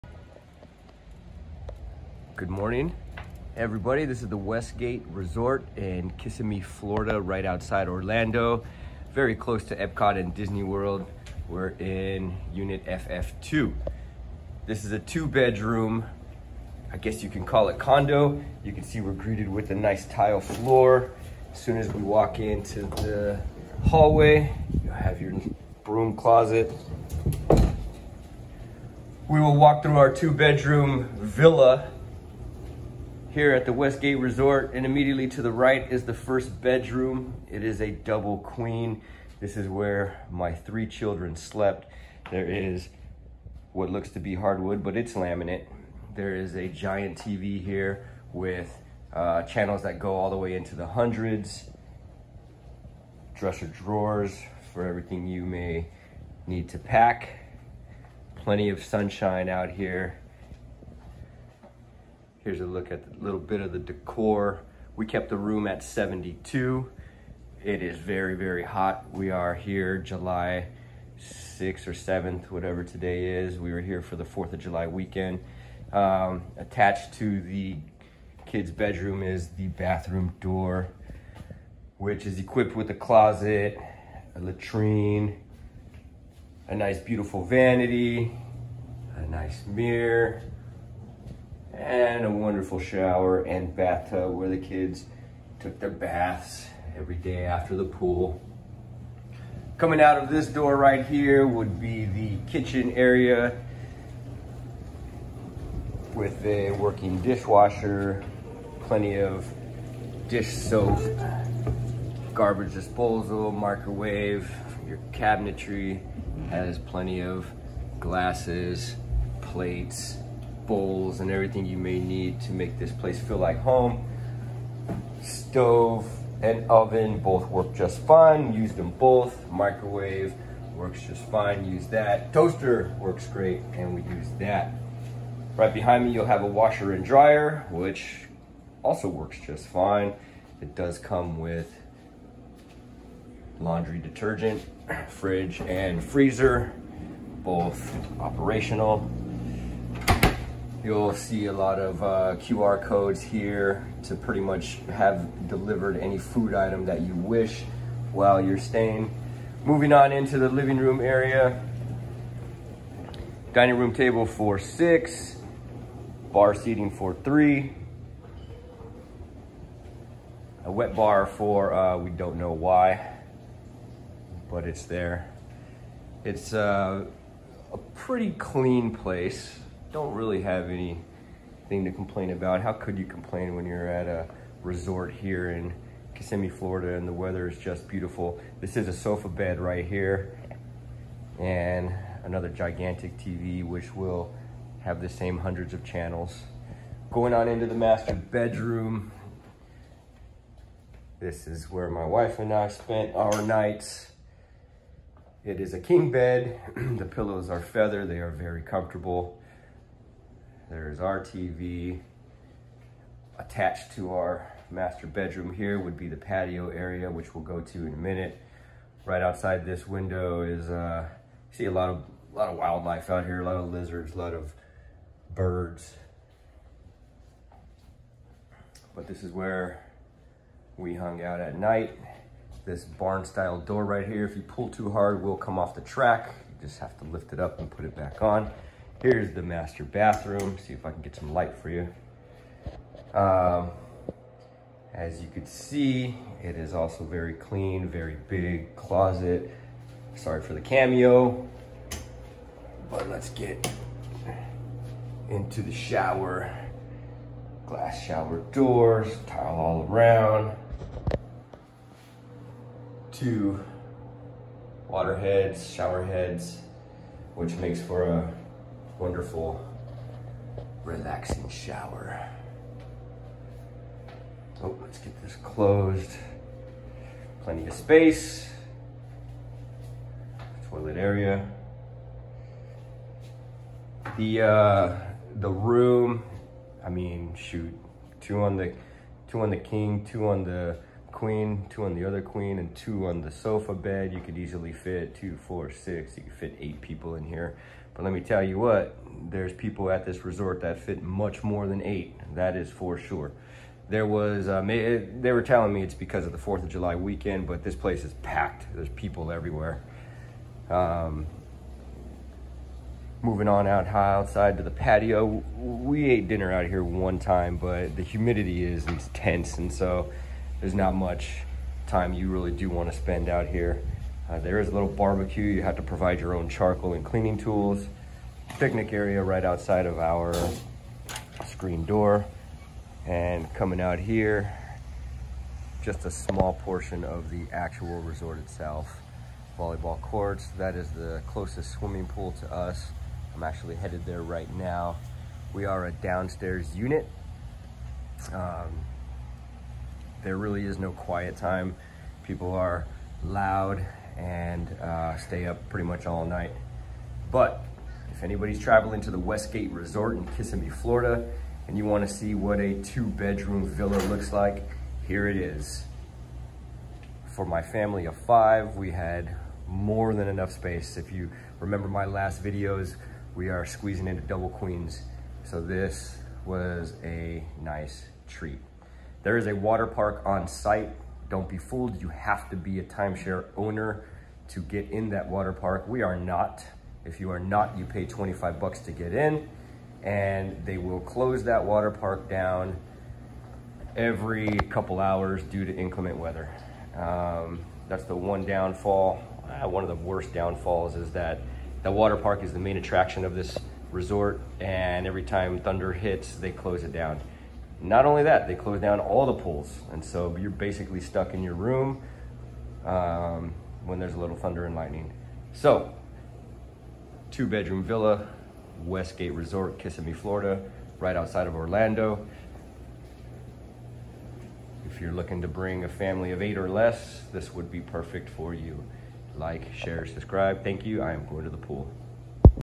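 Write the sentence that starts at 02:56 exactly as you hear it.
It's uh, a pretty clean place don't really have anything to complain about.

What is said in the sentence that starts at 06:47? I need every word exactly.
Not only that, they close down all the pools.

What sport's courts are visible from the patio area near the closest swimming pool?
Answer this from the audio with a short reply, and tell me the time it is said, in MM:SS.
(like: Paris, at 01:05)
Volleyball, at 05:39.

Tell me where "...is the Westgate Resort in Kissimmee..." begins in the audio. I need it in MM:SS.
00:04.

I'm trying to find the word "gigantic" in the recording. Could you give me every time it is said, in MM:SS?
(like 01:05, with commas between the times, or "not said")
03:12.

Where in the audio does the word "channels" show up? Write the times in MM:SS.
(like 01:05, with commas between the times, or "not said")
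00:49, 03:15.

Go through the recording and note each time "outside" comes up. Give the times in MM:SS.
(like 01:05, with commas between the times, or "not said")
00:07, 03:39, 05:14, 05:29, 07:01.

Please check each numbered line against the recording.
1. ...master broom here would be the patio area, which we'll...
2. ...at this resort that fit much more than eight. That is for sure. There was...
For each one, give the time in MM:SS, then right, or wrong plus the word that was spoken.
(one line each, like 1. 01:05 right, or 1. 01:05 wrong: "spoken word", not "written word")
1. 03:34 wrong: "bedroom", not "broom"
2. 04:59 right.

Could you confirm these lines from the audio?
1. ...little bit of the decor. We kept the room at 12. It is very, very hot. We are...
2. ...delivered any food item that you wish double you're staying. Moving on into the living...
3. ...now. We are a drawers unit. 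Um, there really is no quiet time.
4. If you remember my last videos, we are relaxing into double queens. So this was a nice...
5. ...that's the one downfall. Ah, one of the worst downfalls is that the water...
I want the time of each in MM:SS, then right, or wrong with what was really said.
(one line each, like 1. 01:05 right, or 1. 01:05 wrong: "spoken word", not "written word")
1. 01:03 wrong: "72", not "12"
2. 02:35 wrong: "while", not "double"
3. 05:44 wrong: "downstairs", not "drawers"
4. 06:10 wrong: "squeezing", not "relaxing"
5. 06:37 right.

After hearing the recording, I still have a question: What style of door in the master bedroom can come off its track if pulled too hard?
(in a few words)
Barn style door.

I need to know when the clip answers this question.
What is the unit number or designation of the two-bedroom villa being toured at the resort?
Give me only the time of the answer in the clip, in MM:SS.
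00:12.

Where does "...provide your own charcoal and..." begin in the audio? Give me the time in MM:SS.
05:25.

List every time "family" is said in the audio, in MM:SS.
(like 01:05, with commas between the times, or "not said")
06:07, 07:05.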